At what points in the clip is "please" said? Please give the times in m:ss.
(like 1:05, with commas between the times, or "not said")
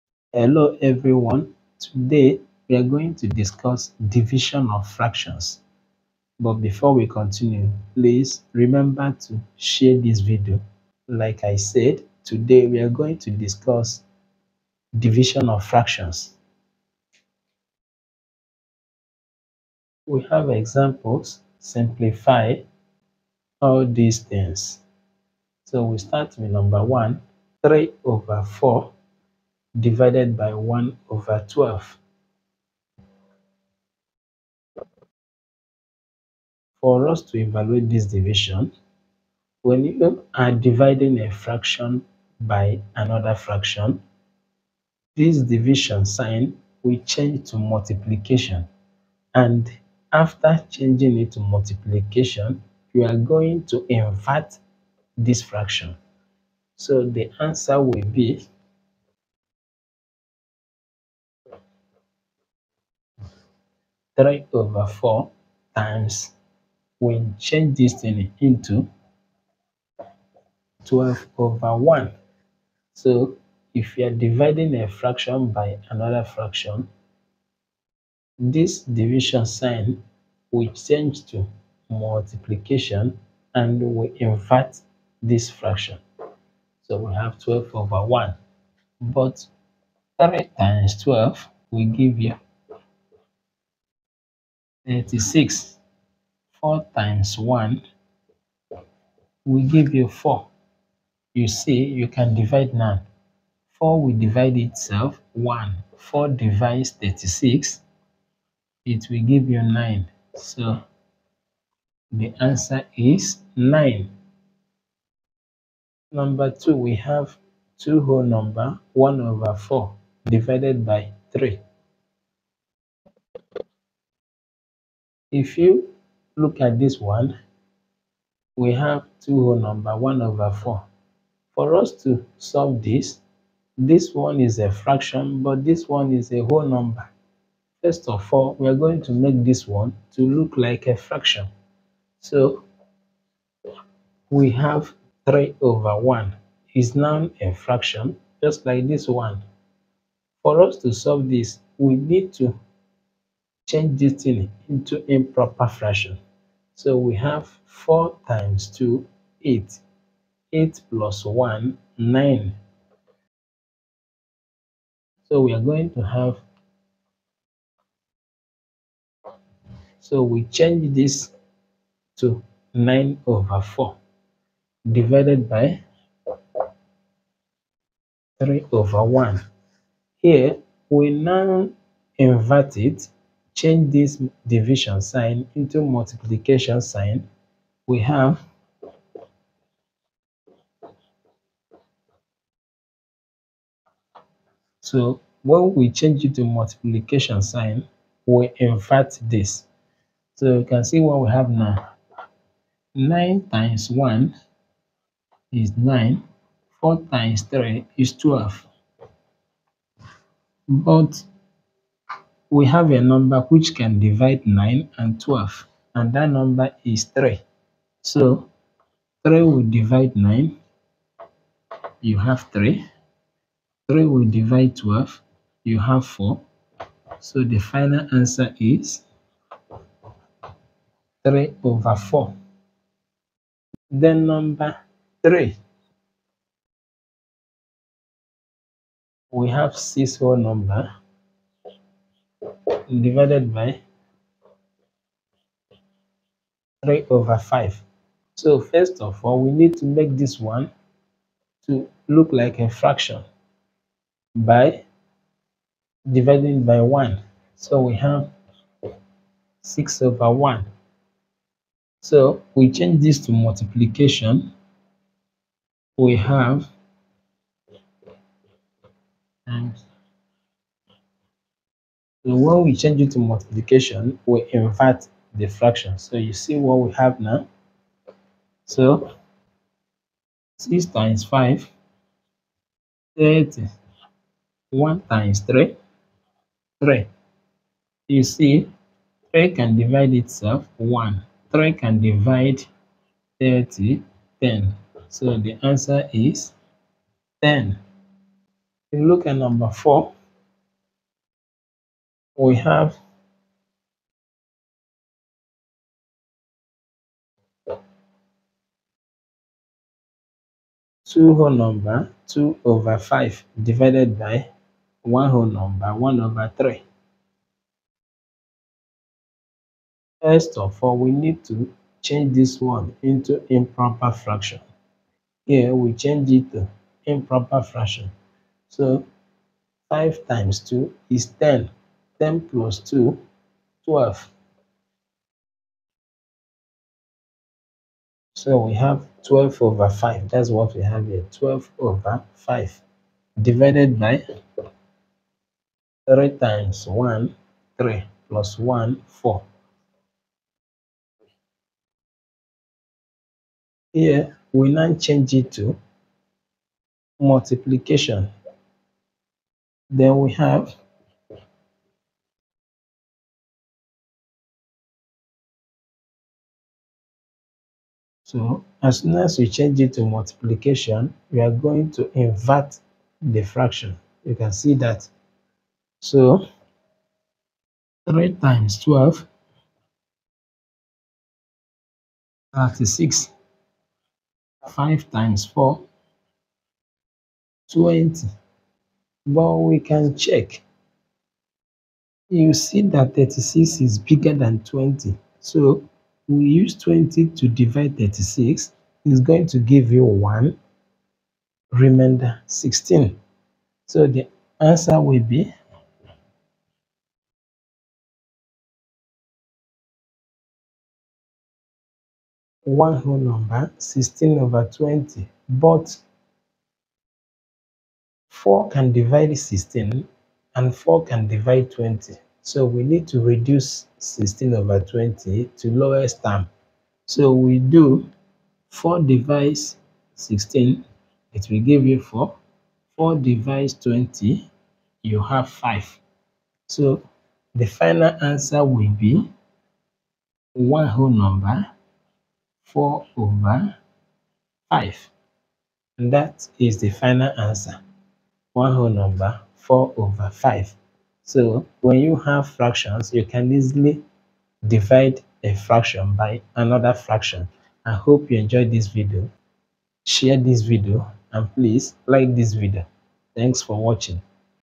0:07, 7:41.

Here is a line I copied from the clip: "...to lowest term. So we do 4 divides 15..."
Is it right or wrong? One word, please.
wrong.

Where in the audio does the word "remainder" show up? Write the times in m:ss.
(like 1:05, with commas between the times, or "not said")
6:41.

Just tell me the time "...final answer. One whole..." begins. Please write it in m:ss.
7:26.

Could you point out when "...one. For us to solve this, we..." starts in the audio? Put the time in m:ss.
2:29.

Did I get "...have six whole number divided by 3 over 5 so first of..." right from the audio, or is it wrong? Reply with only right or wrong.
right.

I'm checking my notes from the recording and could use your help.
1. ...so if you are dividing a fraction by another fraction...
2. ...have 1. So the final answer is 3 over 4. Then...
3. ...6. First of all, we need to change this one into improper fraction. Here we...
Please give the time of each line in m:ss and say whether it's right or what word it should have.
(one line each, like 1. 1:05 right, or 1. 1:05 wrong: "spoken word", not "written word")
1. 1:12 right
2. 3:45 wrong: "4", not "1"
3. 5:16 wrong: "3", not "6".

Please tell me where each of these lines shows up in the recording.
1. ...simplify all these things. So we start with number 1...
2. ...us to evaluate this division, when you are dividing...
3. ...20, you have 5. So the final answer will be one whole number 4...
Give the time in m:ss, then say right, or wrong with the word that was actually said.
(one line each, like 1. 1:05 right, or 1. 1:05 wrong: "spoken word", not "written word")
1. 0:21 right
2. 0:37 right
3. 7:13 right.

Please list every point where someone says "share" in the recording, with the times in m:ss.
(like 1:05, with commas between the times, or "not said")
0:09, 7:40.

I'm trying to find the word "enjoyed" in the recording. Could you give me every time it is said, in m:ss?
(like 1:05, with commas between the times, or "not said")
7:38.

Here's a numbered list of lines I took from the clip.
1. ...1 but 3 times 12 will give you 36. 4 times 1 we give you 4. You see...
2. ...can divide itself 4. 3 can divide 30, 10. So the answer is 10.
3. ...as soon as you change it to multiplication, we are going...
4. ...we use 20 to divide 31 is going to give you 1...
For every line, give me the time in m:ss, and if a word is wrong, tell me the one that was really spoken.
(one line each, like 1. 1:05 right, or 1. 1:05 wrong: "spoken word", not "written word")
1. 1:28 right
2. 4:49 wrong: "1", not "4"
3. 6:08 right
4. 6:36 wrong: "36", not "31".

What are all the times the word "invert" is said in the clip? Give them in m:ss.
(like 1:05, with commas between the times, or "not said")
0:53, 1:24, 3:02, 3:18, 4:34, 6:12.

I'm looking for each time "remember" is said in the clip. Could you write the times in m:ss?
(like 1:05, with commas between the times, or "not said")
0:08.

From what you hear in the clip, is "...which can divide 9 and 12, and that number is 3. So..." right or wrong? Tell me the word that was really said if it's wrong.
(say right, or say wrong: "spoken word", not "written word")
right.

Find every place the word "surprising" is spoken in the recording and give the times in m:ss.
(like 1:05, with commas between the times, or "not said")
not said.